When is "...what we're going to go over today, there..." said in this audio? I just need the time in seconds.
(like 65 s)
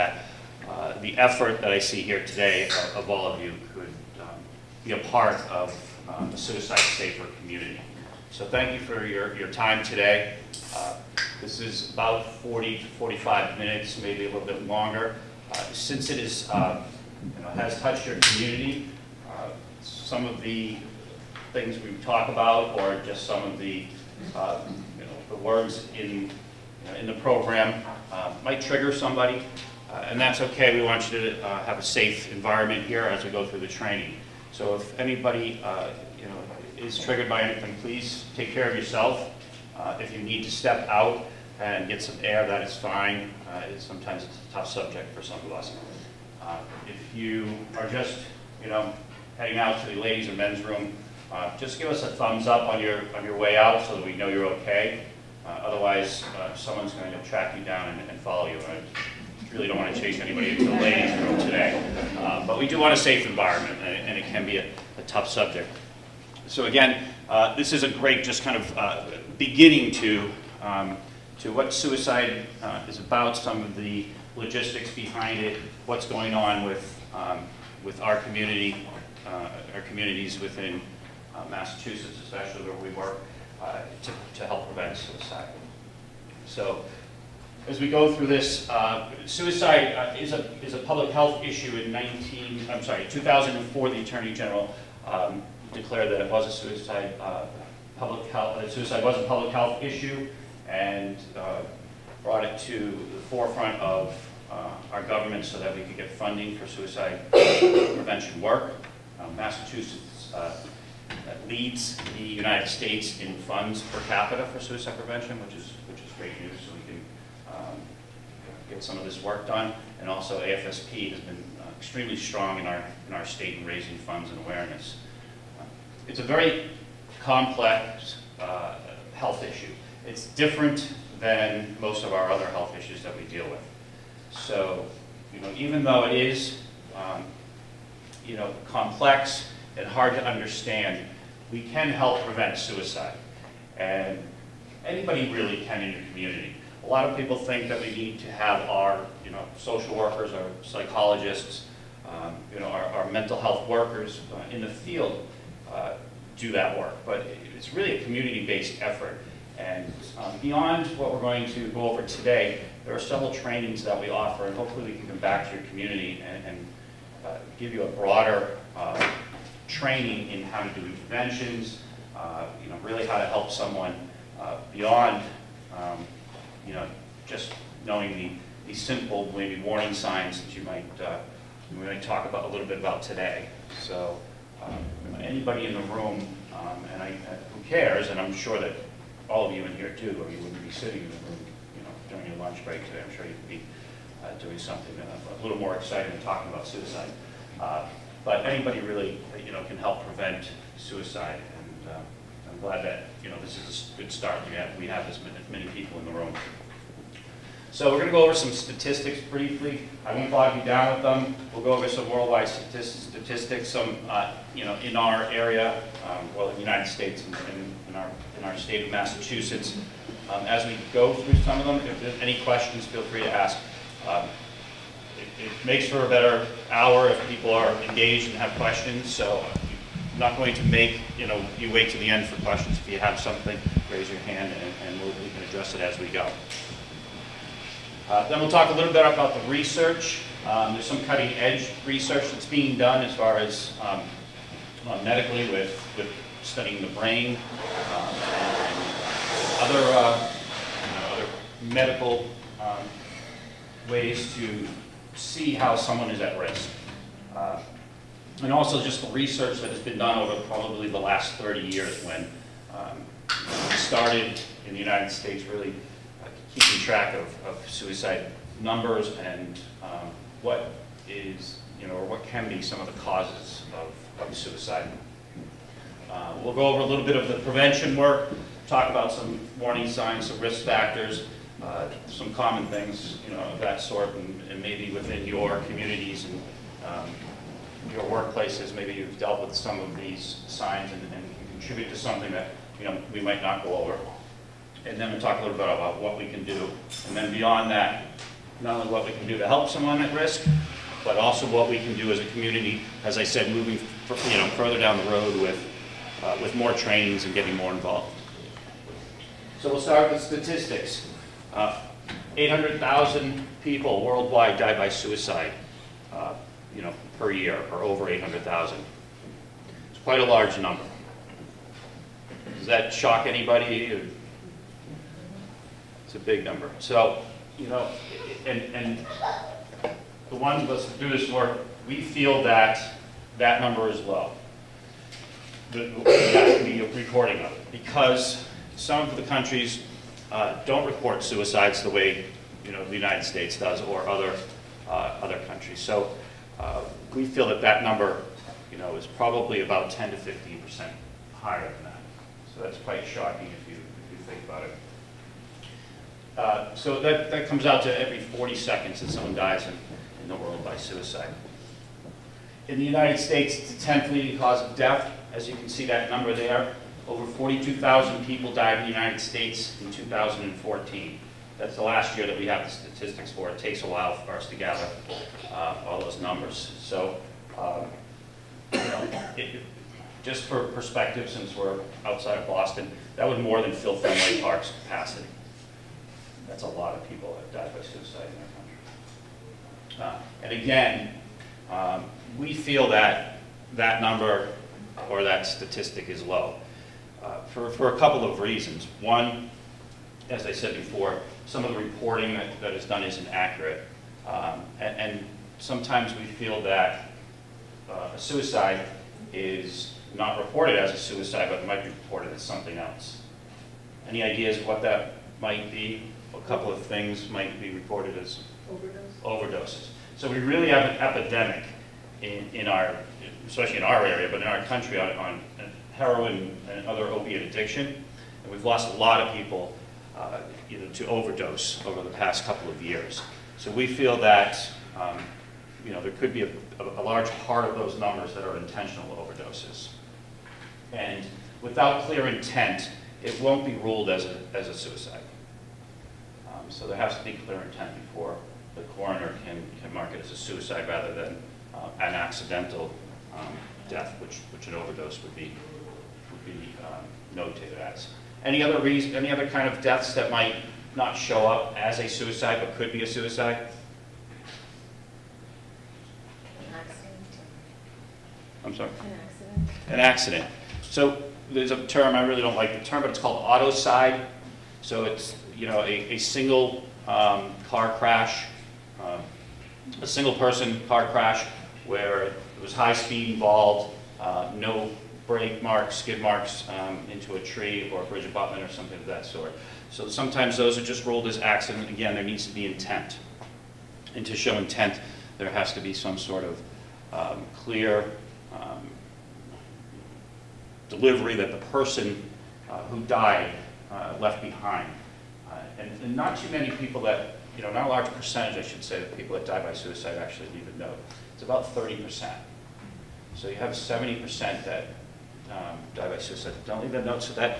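160 s.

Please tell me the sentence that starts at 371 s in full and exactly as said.
That's the last year that we have the statistics for.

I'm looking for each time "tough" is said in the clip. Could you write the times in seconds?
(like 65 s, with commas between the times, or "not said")
44 s, 65 s.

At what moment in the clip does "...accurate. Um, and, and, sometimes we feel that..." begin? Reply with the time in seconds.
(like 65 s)
403 s.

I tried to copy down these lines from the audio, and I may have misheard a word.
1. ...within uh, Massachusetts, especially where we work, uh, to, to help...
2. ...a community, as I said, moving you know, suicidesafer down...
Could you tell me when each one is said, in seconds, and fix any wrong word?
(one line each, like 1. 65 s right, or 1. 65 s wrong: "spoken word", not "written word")
1. 80 s right
2. 302 s wrong: "further", not "suicidesafer".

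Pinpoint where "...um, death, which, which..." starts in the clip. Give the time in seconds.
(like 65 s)
453 s.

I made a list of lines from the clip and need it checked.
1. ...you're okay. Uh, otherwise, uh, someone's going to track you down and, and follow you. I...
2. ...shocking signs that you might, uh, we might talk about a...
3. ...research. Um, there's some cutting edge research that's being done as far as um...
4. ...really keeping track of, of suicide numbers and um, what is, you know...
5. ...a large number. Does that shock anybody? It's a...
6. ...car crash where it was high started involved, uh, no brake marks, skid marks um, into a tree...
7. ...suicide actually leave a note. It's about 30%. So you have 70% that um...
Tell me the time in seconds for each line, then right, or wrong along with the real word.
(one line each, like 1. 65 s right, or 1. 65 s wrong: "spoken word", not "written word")
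1. 54 s right
2. 179 s wrong: "warning", not "shocking"
3. 239 s right
4. 265 s right
5. 320 s right
6. 480 s wrong: "speed", not "started"
7. 509 s right.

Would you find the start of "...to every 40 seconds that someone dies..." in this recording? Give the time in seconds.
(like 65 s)
357 s.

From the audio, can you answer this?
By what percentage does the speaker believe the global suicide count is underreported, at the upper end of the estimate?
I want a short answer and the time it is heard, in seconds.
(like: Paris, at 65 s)
15 percent, at 350 s.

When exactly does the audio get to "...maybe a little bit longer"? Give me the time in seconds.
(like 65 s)
14 s.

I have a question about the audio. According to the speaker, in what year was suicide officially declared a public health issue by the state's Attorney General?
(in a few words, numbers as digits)
2004.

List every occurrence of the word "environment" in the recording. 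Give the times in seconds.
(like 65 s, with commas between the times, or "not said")
32 s, 63 s.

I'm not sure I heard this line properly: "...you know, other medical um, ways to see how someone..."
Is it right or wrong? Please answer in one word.
right.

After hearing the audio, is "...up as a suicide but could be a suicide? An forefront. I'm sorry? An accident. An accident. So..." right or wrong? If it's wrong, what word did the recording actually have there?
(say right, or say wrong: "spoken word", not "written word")
wrong: "accident", not "forefront".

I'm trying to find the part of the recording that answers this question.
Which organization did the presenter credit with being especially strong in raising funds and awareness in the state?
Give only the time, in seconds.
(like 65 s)
120 s.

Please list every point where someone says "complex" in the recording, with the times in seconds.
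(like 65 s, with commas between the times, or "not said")
127 s, 138 s.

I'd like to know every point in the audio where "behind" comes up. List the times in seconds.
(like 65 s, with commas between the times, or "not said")
74 s, 504 s.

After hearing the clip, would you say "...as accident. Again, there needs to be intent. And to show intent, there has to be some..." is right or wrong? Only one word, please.
right.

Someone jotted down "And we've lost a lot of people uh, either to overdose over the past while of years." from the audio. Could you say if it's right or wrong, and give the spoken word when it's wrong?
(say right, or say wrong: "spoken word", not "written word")
wrong: "couple", not "while".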